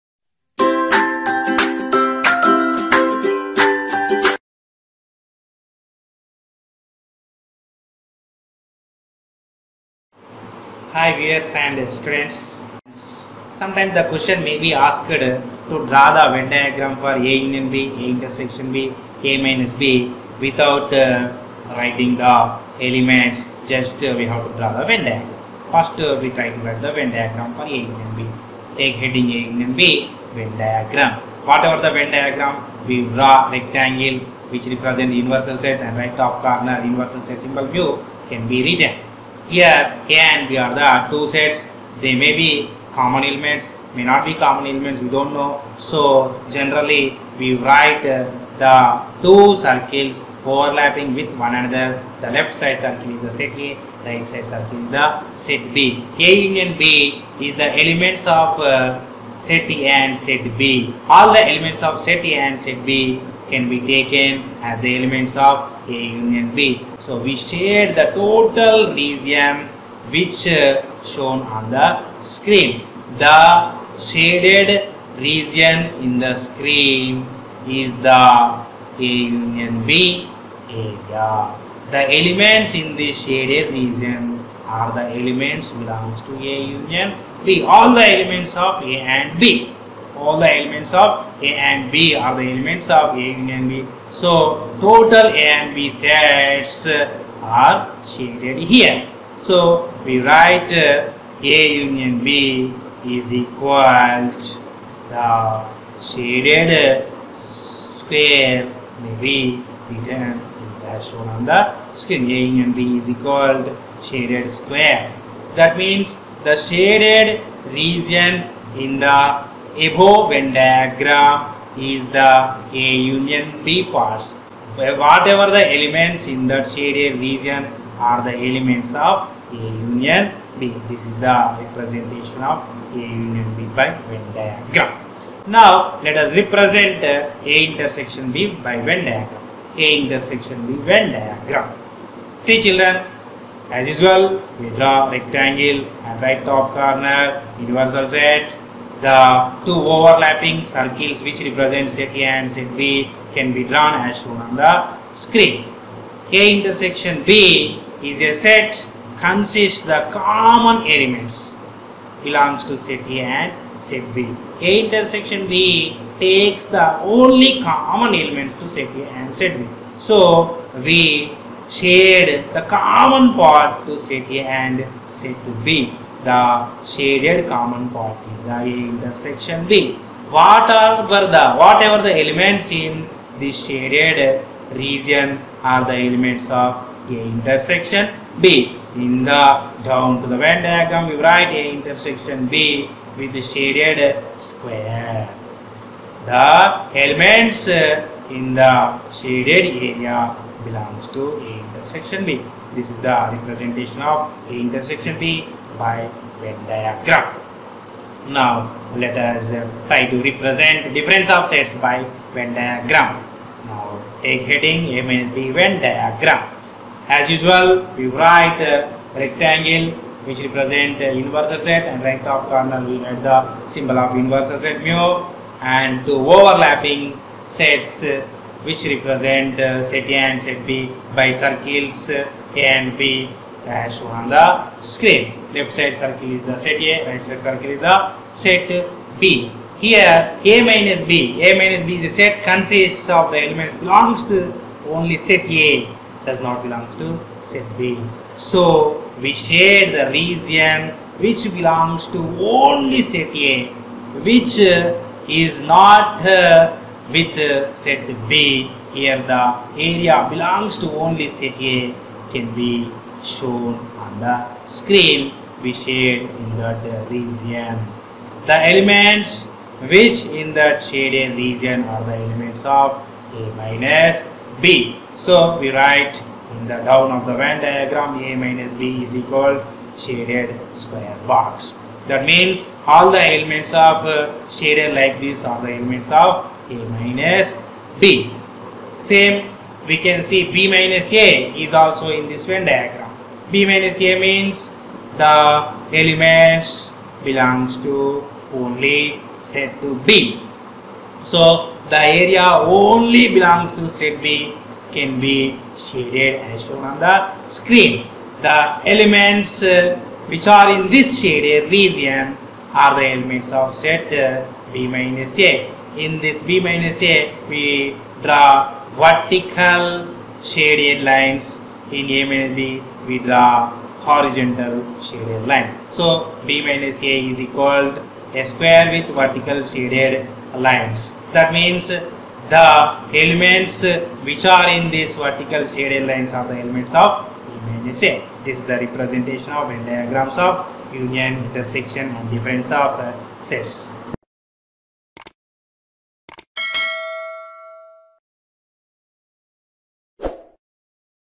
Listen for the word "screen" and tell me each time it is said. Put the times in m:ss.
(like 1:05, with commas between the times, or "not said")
1:12, 1:16, 1:51, 2:35, 3:54, 4:24, 5:07.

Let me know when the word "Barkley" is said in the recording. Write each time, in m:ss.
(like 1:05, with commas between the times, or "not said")
not said.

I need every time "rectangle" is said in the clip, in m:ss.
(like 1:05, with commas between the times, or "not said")
0:33, 2:25, 3:39.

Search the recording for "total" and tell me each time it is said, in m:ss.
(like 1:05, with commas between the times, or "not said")
1:08, 1:34.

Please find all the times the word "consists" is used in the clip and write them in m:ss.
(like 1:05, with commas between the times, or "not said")
2:39, 4:02.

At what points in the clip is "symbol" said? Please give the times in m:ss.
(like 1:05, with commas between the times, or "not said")
0:37, 3:43.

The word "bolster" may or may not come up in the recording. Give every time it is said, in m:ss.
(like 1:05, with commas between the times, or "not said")
not said.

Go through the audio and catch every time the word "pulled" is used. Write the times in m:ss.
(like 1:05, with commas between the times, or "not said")
not said.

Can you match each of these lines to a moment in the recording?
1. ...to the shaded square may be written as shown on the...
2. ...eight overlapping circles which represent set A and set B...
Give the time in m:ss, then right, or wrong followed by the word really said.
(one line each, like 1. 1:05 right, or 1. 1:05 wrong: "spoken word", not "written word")
1. 1:44 right
2. 2:29 wrong: "two", not "eight".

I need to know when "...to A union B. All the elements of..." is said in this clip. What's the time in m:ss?
1:26.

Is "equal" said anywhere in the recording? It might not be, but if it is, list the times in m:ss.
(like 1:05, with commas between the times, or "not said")
1:43, 1:53, 4:39, 5:27.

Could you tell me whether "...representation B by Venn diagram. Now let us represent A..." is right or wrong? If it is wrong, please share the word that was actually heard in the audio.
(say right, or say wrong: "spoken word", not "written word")
wrong: "union", not "representation".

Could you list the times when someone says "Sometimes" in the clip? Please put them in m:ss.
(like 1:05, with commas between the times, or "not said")
0:13.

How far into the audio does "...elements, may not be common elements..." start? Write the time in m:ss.
0:43.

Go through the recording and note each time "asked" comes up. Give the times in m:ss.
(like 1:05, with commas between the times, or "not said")
0:14.